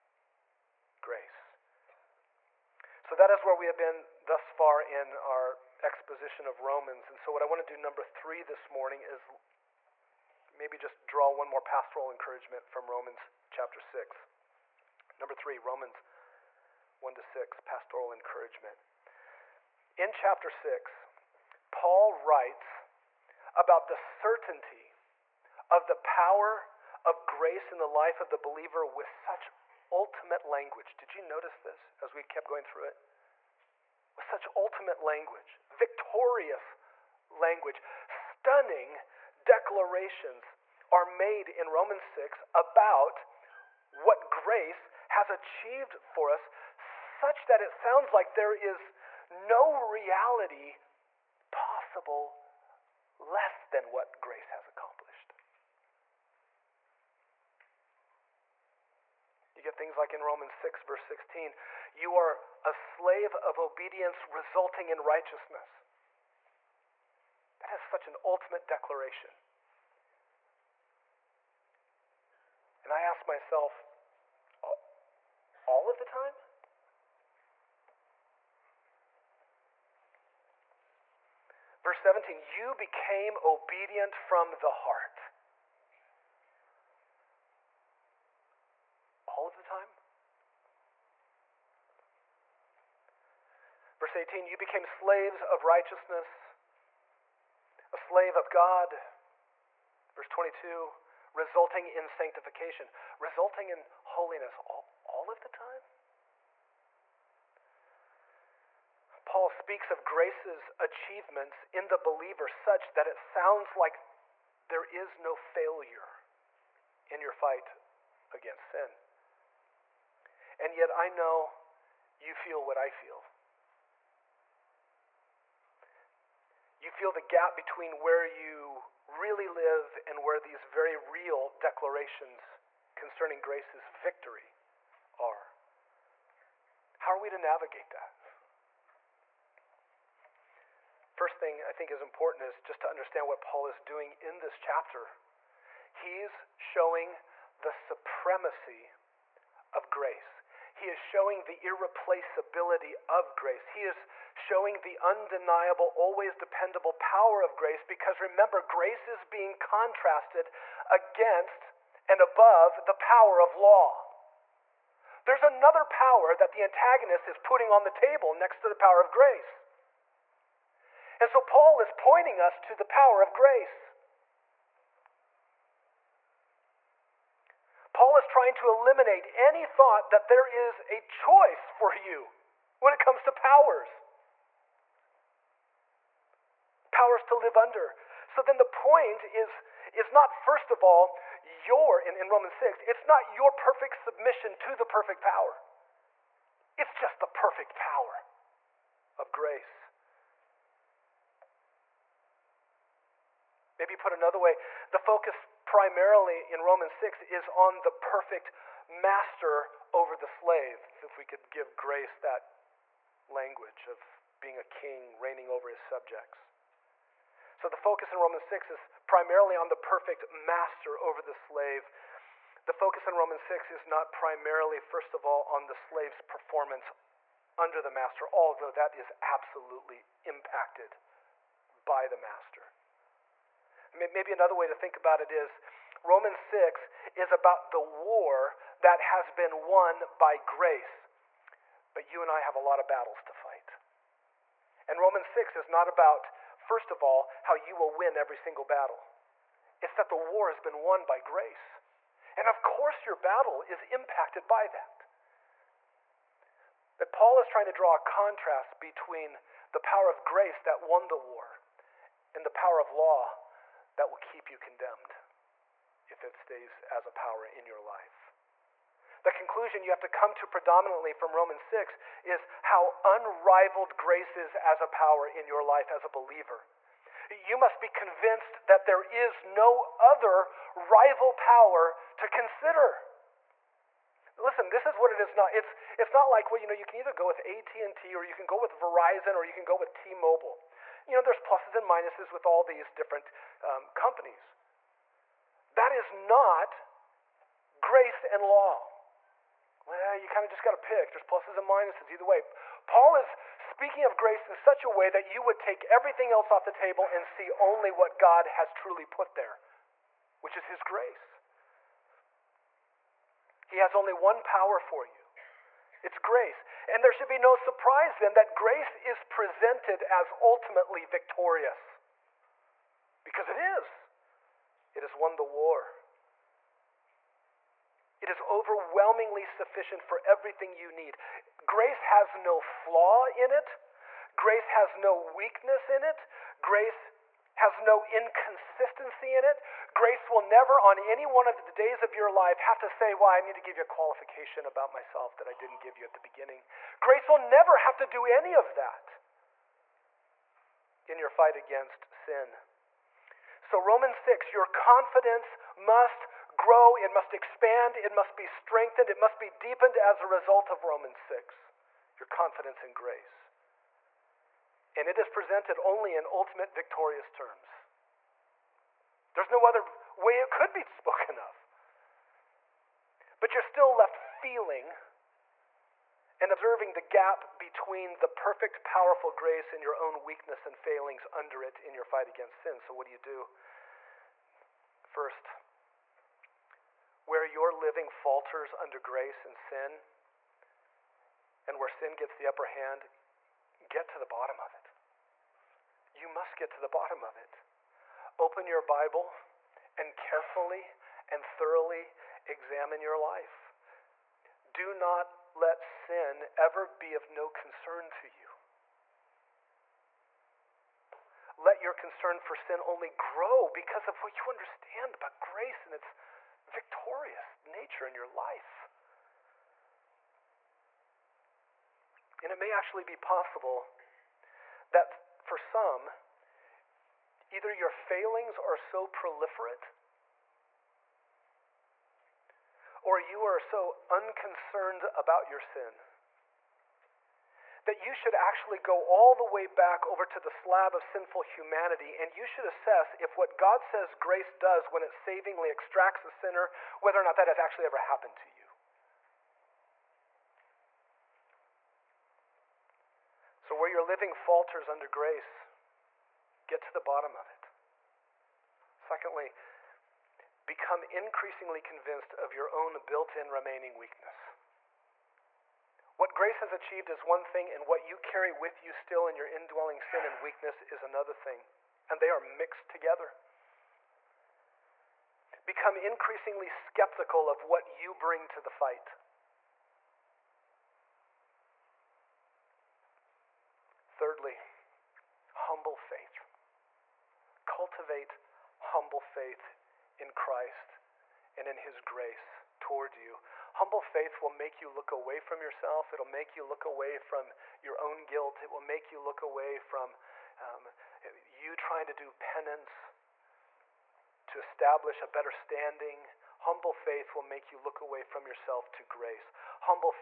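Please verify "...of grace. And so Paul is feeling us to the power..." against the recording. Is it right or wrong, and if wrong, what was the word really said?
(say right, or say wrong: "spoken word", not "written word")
wrong: "pointing", not "feeling".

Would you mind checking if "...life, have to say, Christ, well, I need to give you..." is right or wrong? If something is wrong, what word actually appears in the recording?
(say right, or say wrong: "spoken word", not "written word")
wrong: "Why", not "Christ".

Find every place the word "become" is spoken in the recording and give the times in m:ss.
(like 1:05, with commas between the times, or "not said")
7:40, 7:55.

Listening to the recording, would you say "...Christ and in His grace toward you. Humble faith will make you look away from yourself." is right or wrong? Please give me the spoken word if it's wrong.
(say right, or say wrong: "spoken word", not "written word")
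right.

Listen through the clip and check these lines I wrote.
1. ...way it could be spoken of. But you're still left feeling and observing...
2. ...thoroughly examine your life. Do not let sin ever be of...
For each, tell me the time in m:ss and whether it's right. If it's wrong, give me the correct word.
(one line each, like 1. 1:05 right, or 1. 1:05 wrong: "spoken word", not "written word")
1. 6:10 right
2. 6:41 right.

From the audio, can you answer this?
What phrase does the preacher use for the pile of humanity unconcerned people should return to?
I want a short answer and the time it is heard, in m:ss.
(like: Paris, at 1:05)
Slab of sinful humanity, at 7:20.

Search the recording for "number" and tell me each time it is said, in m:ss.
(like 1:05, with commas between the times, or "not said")
0:07, 0:15.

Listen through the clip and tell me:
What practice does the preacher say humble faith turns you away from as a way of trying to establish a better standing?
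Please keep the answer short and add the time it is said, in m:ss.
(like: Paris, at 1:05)
Penance, at 8:22.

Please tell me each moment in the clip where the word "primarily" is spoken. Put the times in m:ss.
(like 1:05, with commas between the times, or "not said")
3:25, 3:39, 3:44.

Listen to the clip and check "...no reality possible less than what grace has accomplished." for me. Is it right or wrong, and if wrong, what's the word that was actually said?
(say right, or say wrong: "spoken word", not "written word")
right.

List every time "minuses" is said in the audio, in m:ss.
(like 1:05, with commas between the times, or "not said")
4:51, 5:01.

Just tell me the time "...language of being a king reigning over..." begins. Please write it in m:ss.
3:33.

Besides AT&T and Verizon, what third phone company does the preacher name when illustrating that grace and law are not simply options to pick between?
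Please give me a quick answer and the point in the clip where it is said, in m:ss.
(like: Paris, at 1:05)
T-Mobile, at 4:49.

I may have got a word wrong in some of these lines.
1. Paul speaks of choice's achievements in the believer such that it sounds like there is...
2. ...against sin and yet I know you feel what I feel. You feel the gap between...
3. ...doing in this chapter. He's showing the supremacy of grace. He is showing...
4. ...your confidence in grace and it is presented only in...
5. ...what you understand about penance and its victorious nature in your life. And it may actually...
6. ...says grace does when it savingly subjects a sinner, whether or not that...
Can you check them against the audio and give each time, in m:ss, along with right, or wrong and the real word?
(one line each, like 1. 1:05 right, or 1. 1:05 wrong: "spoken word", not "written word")
1. 1:49 wrong: "grace", not "choice"
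2. 1:58 right
3. 2:23 right
4. 6:02 right
5. 6:54 wrong: "grace", not "penance"
6. 7:23 wrong: "extracts", not "subjects".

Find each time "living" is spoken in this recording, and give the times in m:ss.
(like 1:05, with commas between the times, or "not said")
6:27, 7:34.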